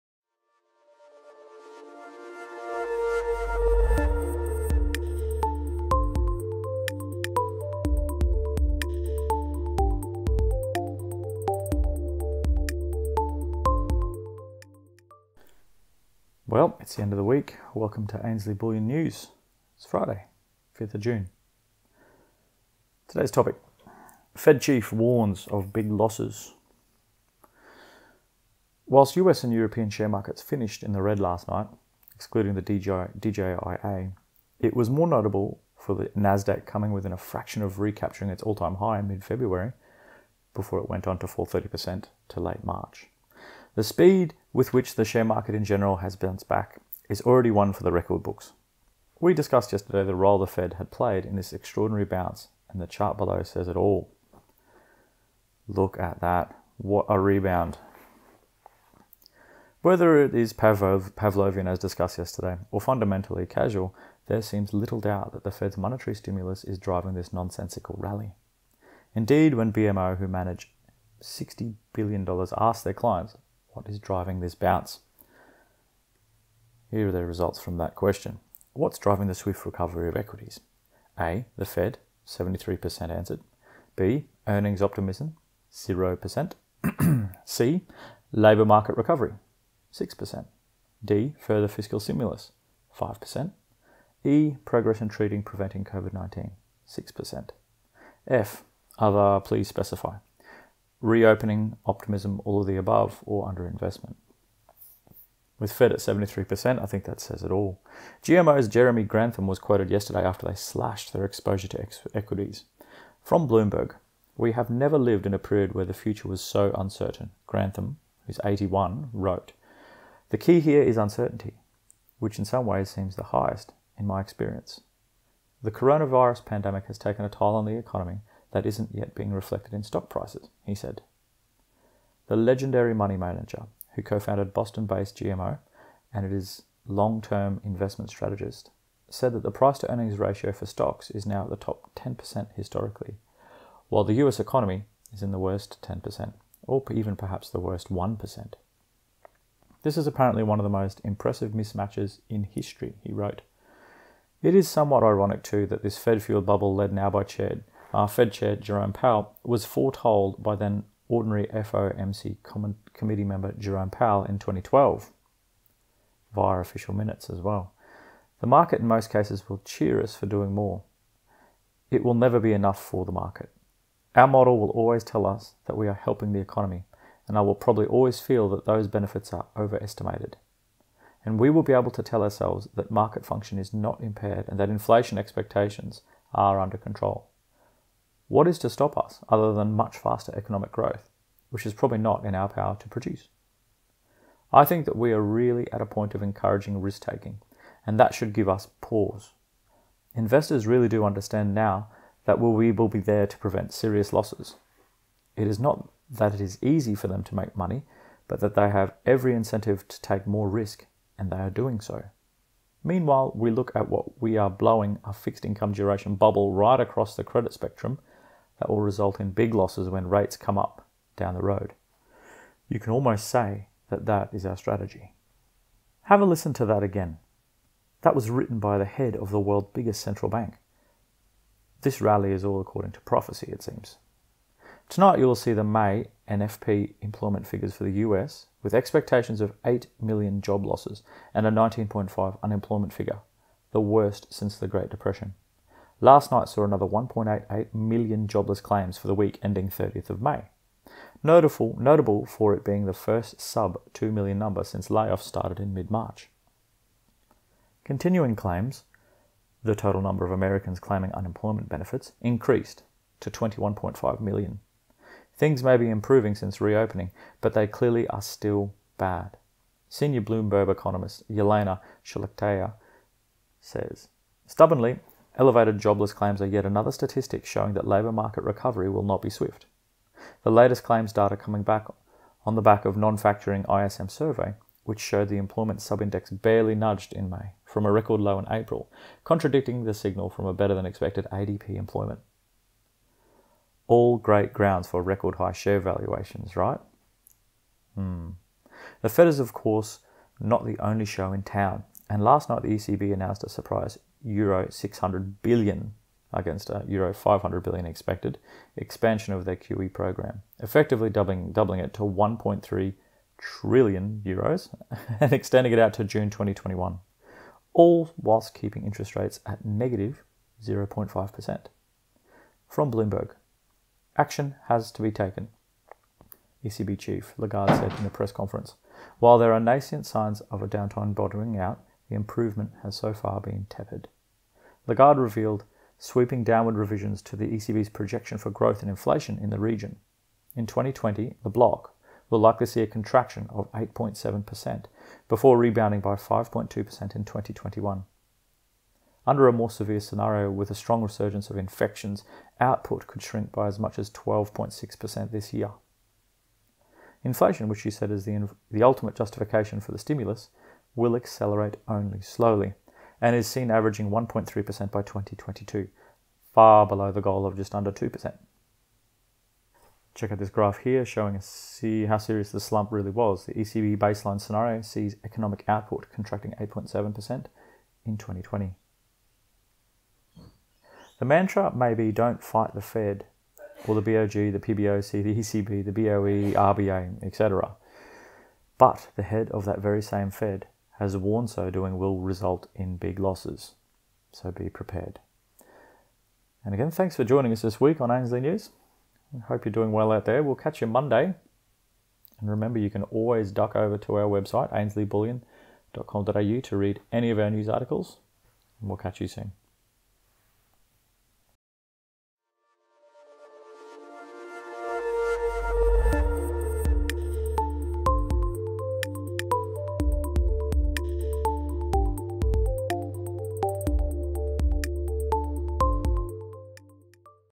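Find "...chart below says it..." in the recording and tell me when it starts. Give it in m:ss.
0:52.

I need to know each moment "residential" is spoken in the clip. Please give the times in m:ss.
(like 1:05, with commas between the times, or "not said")
not said.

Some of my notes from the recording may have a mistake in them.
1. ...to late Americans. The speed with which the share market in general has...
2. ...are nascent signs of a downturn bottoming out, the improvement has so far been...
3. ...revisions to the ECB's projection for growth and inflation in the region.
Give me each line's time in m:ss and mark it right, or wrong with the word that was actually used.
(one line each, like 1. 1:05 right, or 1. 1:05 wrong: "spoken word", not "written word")
1. 0:42 wrong: "March", not "Americans"
2. 5:29 right
3. 5:36 right.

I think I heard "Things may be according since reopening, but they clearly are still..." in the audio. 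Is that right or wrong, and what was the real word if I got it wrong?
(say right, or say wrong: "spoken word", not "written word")
wrong: "improving", not "according".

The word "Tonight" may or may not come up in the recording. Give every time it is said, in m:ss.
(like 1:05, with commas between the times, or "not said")
3:54.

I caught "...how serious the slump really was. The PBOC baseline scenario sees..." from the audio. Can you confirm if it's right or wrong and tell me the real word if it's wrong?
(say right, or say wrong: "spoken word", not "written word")
wrong: "ECB", not "PBOC".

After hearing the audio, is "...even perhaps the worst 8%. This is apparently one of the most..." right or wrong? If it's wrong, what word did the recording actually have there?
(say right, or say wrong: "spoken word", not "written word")
wrong: "1", not "8".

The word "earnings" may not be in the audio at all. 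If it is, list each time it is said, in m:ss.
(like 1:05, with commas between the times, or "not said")
1:24, 2:19.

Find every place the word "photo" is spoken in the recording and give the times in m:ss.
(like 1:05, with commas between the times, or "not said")
not said.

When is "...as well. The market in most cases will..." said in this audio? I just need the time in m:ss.
2:47.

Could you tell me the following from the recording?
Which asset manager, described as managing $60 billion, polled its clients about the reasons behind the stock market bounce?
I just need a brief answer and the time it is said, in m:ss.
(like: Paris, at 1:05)
BMO, at 1:09.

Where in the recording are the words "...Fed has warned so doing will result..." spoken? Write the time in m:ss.
6:30.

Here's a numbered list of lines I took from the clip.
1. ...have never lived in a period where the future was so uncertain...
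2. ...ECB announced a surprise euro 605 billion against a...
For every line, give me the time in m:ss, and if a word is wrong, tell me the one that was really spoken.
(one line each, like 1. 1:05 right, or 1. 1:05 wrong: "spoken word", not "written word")
1. 1:54 right
2. 5:02 wrong: "600", not "605".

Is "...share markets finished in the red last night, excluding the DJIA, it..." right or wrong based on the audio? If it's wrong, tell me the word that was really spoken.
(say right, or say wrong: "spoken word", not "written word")
right.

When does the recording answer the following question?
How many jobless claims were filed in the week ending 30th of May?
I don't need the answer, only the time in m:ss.
4:06.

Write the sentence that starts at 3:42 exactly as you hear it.
You can almost say that that is our strategy.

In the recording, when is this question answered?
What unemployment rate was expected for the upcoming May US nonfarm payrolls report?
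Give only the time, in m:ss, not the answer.
4:01.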